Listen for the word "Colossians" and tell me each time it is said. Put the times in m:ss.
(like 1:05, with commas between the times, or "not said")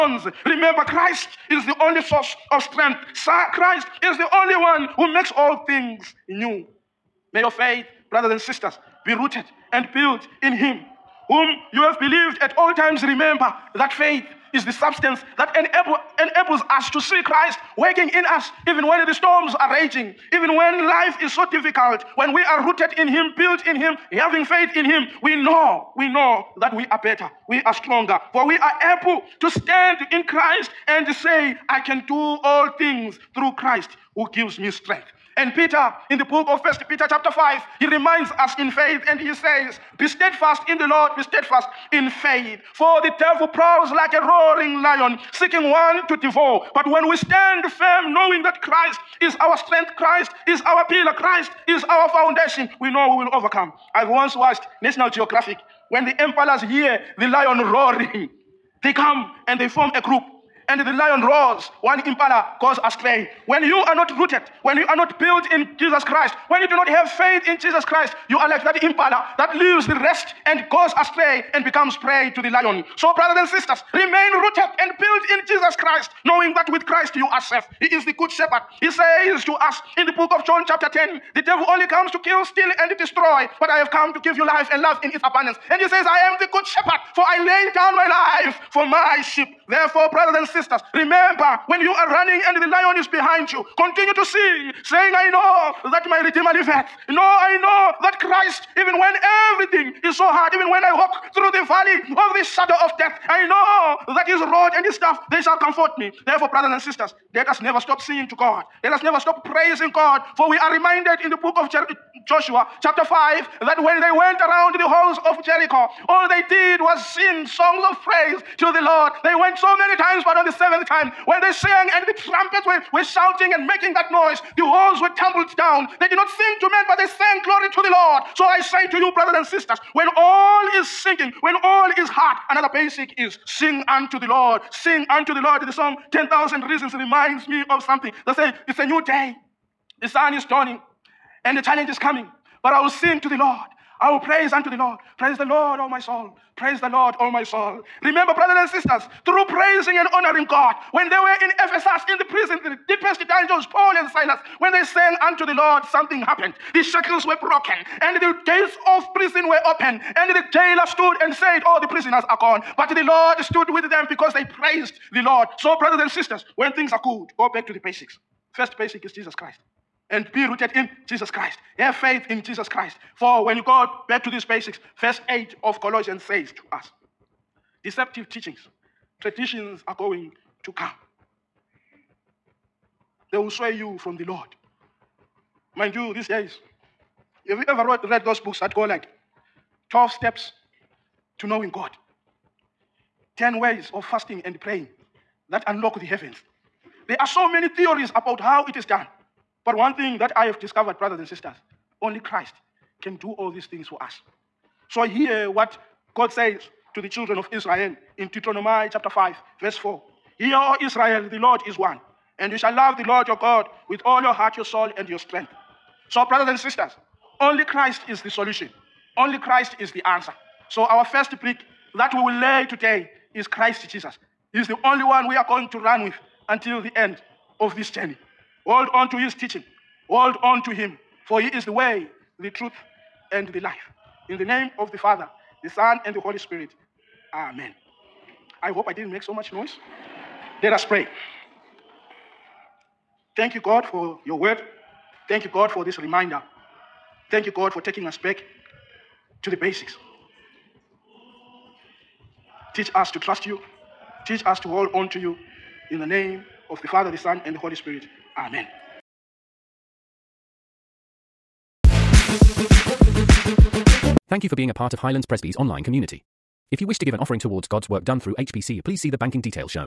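2:55.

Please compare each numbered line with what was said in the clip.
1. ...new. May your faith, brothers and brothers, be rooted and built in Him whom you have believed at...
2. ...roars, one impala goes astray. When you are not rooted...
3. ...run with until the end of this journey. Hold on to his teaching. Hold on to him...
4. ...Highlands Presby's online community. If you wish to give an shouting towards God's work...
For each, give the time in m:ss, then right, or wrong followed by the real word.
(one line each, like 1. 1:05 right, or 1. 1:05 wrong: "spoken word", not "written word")
1. 0:06 wrong: "sisters", not "brothers"
2. 1:01 right
3. 3:45 right
4. 4:24 wrong: "offering", not "shouting".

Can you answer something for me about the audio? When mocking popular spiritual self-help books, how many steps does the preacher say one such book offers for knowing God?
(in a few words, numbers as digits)
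12.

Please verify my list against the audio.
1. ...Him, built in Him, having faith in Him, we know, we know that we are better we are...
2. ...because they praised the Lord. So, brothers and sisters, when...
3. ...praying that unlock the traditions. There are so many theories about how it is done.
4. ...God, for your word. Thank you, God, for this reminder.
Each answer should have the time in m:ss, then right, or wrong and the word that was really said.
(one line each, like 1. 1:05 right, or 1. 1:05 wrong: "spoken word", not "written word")
1. 0:23 right
2. 2:44 right
3. 3:14 wrong: "heavens", not "traditions"
4. 4:03 right.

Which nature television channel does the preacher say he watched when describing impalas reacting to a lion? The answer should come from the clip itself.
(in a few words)
National Geographic.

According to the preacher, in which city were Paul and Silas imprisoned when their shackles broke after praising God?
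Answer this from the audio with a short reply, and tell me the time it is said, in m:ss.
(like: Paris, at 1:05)
Ephesus, at 2:31.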